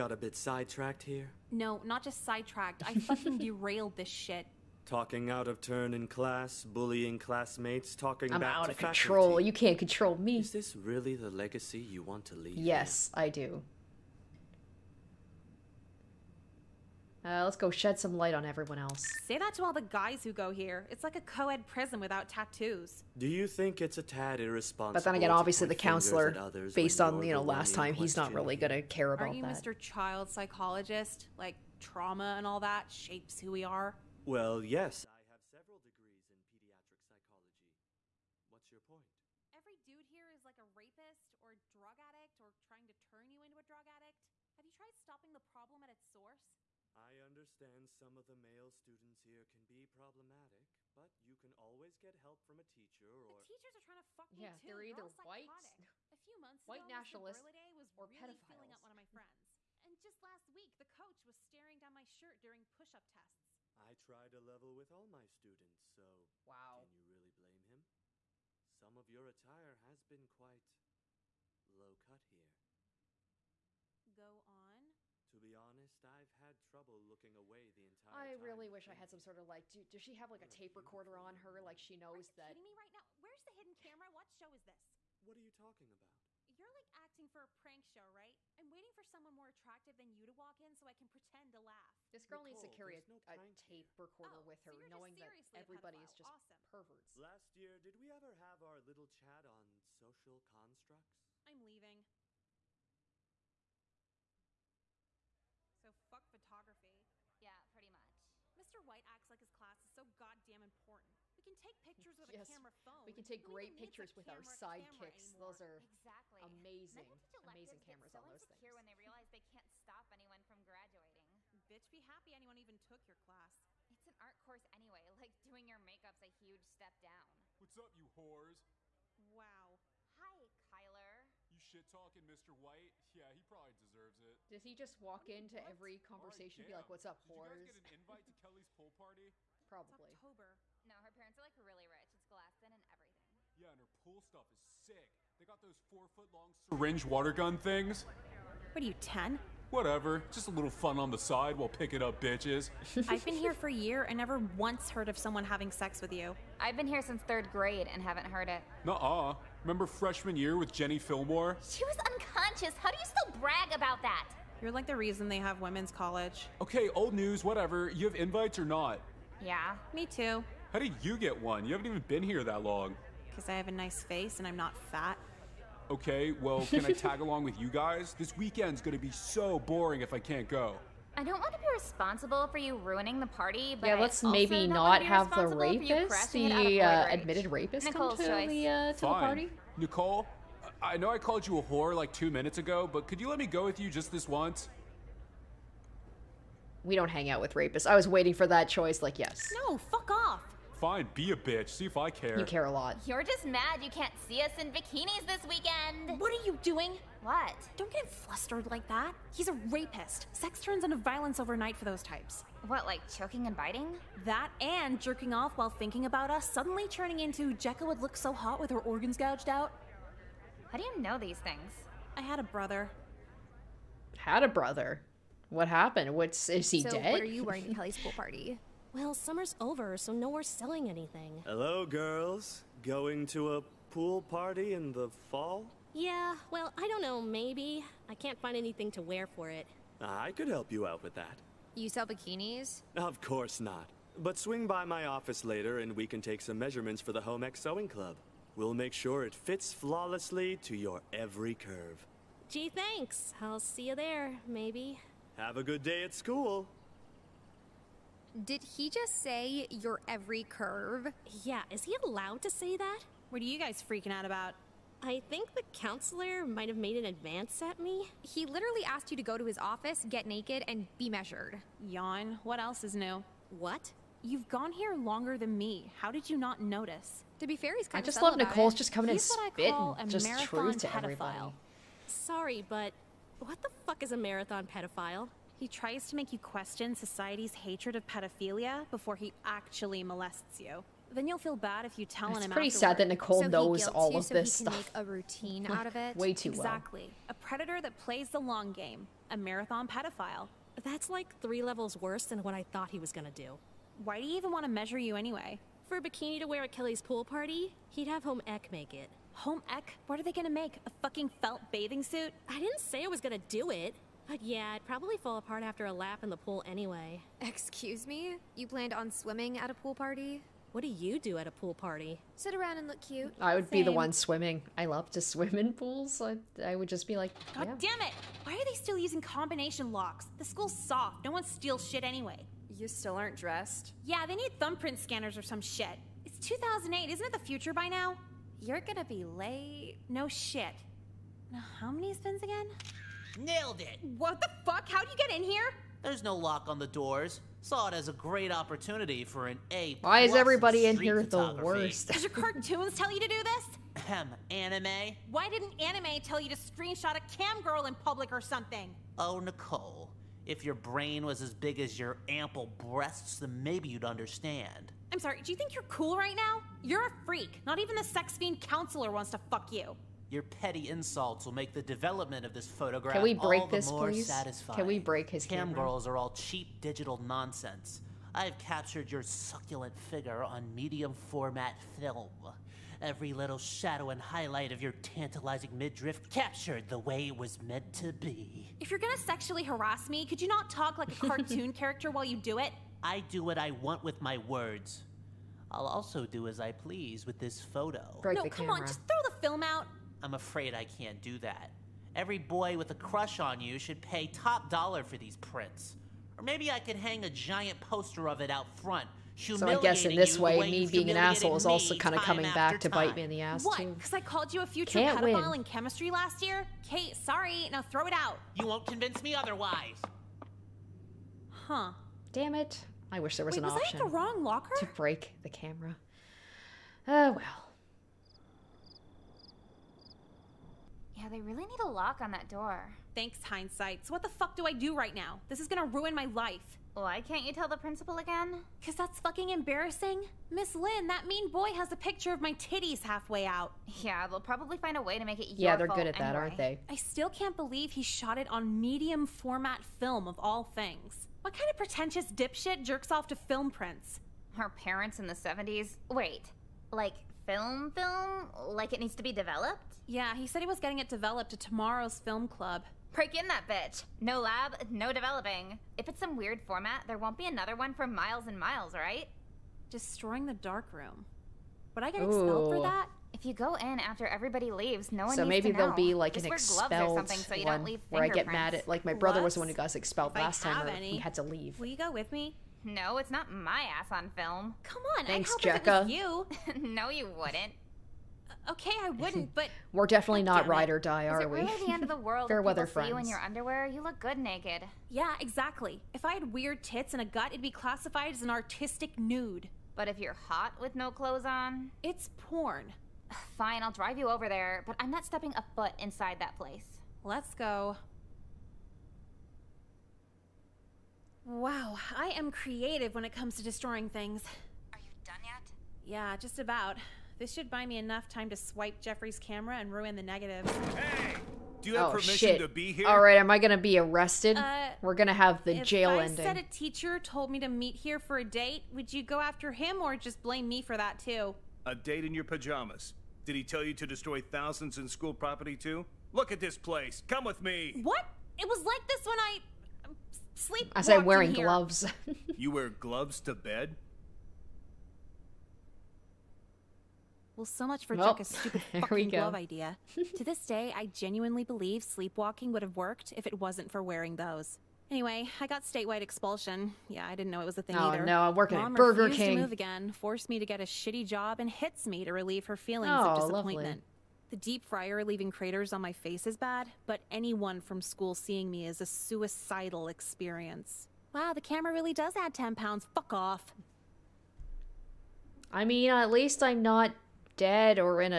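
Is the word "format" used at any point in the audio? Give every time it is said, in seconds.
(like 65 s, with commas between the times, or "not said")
381 s, 449 s, 466 s.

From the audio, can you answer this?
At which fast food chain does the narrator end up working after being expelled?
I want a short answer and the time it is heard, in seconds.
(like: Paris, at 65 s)
Burger King, at 558 s.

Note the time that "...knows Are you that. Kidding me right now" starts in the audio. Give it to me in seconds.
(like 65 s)
81 s.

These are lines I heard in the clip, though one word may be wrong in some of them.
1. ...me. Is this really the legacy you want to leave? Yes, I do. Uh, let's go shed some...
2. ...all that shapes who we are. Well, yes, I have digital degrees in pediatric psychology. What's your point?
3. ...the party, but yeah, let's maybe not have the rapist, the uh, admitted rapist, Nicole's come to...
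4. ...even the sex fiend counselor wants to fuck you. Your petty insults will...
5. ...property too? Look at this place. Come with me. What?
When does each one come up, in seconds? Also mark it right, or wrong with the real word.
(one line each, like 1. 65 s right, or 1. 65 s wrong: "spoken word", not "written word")
1. 10 s right
2. 32 s wrong: "several", not "digital"
3. 183 s right
4. 367 s right
5. 535 s right.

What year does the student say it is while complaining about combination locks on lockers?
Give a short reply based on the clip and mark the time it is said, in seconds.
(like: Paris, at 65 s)
2008, at 336 s.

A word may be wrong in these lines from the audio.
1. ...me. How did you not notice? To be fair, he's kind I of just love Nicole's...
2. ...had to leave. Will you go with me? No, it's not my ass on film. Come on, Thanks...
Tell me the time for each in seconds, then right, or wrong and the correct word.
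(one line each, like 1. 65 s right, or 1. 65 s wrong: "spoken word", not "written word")
1. 275 s right
2. 481 s right.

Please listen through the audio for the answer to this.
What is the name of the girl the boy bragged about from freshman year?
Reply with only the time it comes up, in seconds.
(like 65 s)
160 s.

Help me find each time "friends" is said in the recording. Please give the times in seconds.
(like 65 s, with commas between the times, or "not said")
59 s, 492 s.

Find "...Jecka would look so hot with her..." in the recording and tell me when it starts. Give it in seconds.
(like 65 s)
217 s.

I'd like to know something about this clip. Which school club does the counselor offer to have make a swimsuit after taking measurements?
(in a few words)
Home Ec Sewing Club.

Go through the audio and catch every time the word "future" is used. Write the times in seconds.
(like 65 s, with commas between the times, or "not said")
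337 s, 414 s.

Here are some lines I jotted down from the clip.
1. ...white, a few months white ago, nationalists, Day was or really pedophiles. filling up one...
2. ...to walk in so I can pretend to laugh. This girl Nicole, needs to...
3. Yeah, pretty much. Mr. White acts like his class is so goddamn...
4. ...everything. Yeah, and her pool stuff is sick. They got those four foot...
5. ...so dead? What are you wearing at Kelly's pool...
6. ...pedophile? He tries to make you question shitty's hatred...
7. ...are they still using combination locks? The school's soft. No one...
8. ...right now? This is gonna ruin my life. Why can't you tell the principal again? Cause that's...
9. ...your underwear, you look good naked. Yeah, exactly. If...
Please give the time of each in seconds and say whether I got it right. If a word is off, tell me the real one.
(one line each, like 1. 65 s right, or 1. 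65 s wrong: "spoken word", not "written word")
1. 55 s right
2. 90 s right
3. 107 s right
4. 142 s right
5. 226 s right
6. 284 s wrong: "society", not "shitty"
7. 328 s right
8. 434 s right
9. 493 s right.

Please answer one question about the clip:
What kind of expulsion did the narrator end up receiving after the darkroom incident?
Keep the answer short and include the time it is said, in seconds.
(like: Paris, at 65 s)
statewide expulsion, at 555 s.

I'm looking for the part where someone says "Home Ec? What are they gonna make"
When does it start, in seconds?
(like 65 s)
309 s.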